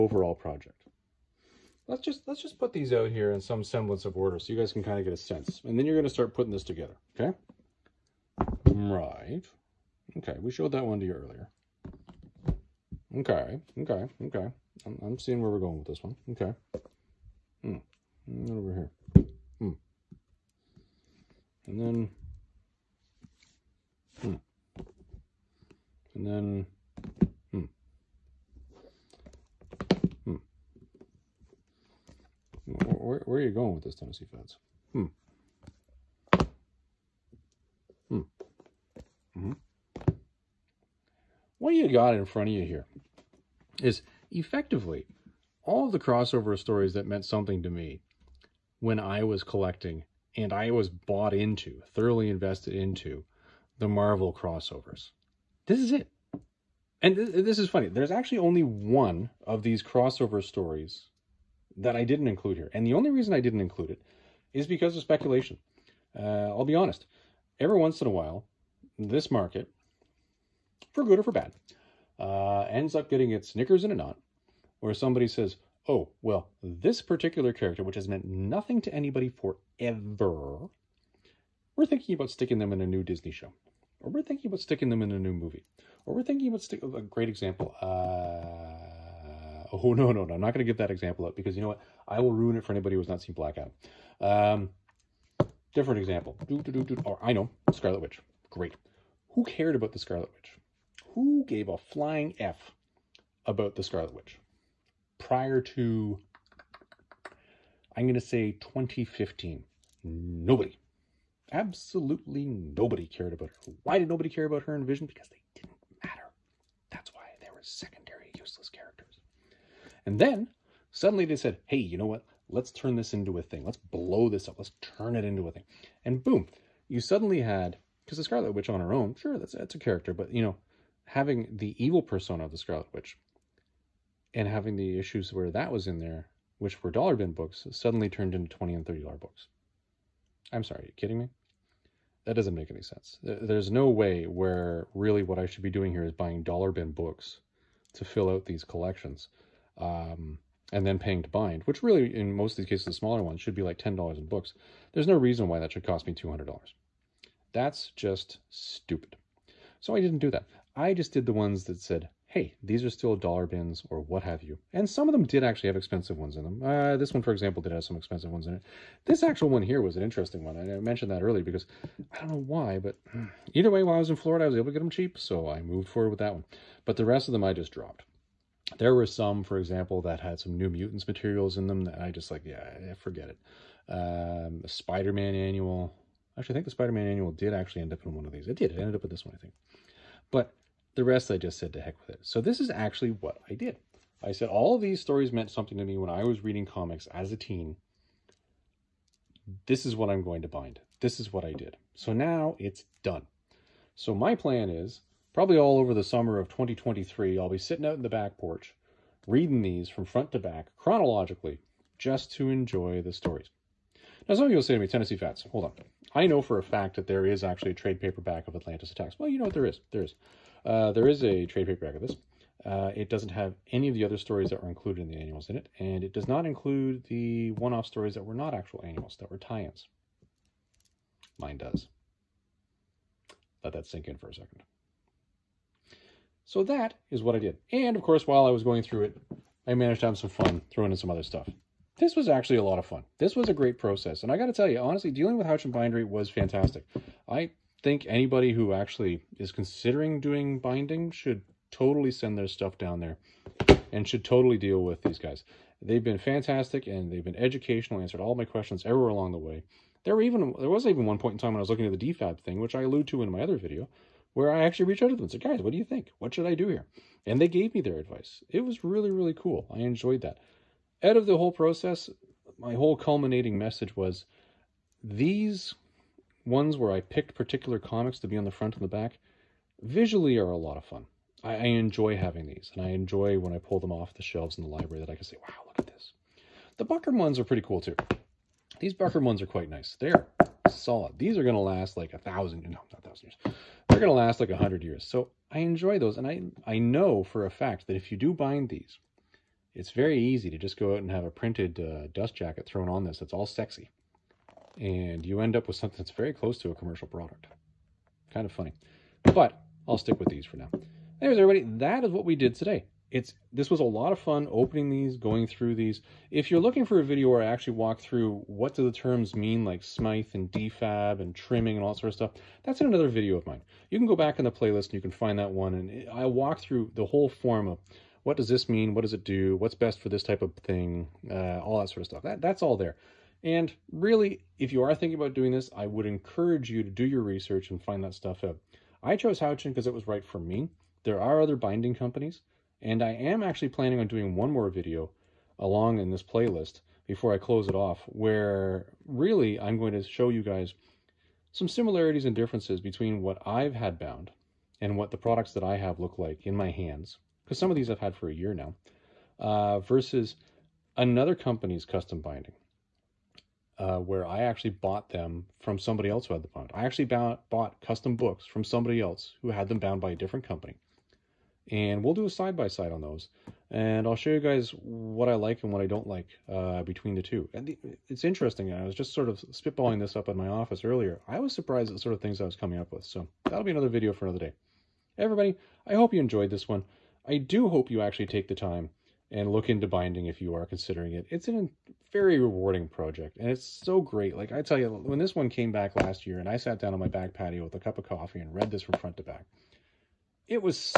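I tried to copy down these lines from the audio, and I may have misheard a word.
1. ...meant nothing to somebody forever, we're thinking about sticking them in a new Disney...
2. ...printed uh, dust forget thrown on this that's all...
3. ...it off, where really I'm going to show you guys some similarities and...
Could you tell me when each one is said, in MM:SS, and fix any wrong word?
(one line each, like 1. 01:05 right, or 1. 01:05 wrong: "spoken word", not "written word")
1. 01:18 wrong: "anybody", not "somebody"
2. 05:01 wrong: "jacket", not "forget"
3. 05:47 right.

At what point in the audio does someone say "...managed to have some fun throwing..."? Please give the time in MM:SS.
03:59.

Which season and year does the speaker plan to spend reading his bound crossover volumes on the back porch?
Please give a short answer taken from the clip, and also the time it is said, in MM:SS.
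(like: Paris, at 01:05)
summer of 2023, at 03:26.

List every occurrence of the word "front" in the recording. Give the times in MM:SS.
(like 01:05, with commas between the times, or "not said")
00:42, 03:30, 04:38, 06:38.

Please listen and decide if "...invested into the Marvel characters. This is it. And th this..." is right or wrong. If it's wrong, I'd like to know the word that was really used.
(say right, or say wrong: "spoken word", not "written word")
wrong: "crossovers", not "characters".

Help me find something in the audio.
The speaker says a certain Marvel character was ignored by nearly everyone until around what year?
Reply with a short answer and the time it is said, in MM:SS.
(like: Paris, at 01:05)
2015, at 01:48.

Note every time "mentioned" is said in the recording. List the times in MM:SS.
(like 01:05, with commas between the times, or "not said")
02:50.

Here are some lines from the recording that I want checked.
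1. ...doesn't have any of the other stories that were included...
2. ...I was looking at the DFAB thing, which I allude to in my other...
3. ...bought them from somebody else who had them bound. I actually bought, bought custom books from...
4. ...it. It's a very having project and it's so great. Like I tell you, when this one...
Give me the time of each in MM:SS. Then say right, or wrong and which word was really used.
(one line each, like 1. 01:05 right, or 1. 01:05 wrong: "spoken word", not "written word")
1. 03:43 right
2. 04:21 right
3. 06:04 right
4. 06:31 wrong: "rewarding", not "having".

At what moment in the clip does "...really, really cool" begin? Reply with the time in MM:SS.
04:28.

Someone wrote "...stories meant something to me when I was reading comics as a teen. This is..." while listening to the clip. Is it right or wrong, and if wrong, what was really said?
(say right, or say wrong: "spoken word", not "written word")
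right.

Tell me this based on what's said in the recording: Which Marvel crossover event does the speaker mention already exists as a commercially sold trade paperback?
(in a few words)
Atlantis Attacks.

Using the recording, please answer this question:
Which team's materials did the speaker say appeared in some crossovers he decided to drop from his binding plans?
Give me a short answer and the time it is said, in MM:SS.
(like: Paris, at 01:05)
New Mutants, at 03:00.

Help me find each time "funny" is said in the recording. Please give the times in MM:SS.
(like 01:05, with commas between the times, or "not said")
00:57, 05:08.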